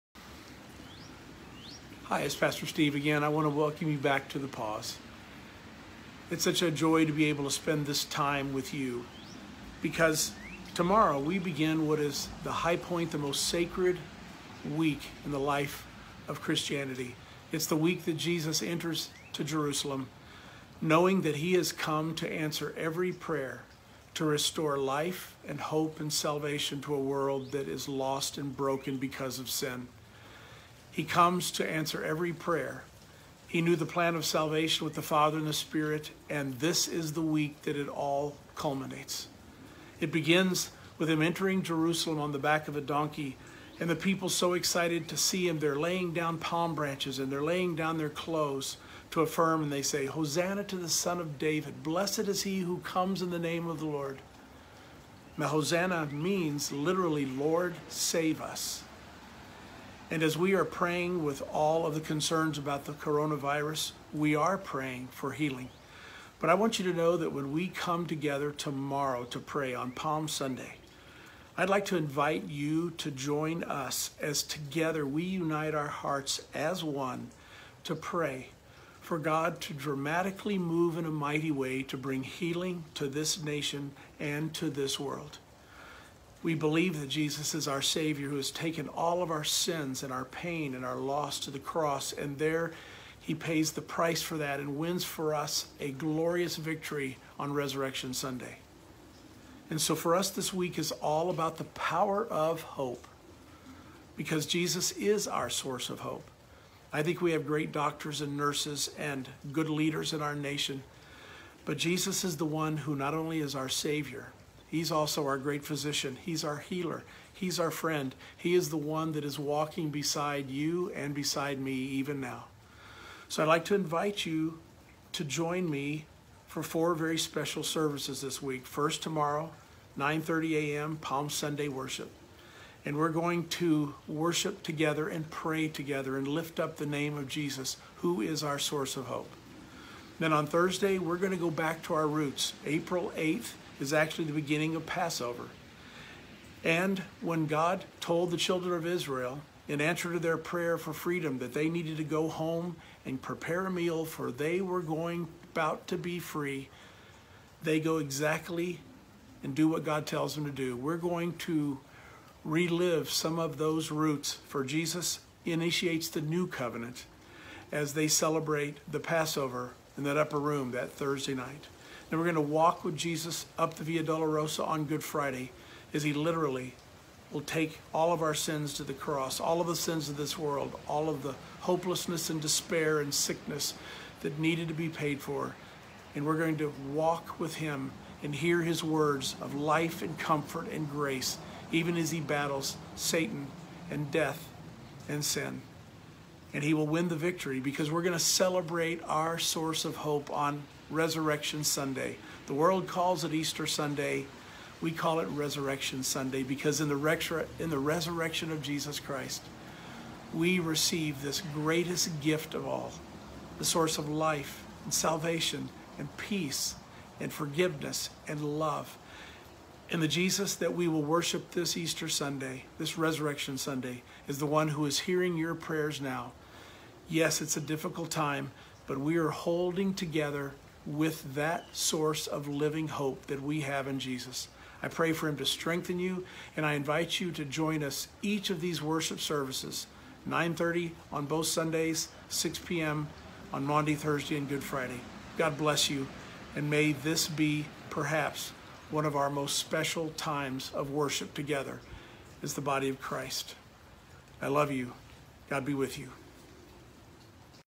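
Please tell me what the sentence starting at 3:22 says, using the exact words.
The world calls it Easter Sunday.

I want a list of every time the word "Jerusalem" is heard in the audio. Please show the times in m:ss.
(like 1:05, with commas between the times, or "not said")
0:19, 0:41.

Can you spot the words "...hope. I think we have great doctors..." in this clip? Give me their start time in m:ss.
1:45.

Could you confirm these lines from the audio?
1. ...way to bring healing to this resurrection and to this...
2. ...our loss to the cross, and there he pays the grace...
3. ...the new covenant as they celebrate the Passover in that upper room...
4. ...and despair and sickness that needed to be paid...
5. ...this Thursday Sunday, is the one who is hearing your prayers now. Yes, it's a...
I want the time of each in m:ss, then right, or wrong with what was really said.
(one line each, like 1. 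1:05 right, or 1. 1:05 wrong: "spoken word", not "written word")
1. 1:21 wrong: "nation", not "resurrection"
2. 1:30 wrong: "price", not "grace"
3. 2:46 right
4. 3:02 right
5. 3:42 wrong: "Resurrection", not "Thursday".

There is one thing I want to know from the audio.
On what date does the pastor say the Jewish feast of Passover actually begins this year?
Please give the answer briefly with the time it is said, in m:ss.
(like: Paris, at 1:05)
April 8th, at 2:22.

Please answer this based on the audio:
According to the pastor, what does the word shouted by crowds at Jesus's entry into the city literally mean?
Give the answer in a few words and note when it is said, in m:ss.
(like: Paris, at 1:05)
Lord, save us, at 0:57.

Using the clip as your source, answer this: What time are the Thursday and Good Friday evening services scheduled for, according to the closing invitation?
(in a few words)
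6 p.m.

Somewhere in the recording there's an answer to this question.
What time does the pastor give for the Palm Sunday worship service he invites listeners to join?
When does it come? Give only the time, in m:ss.
2:09.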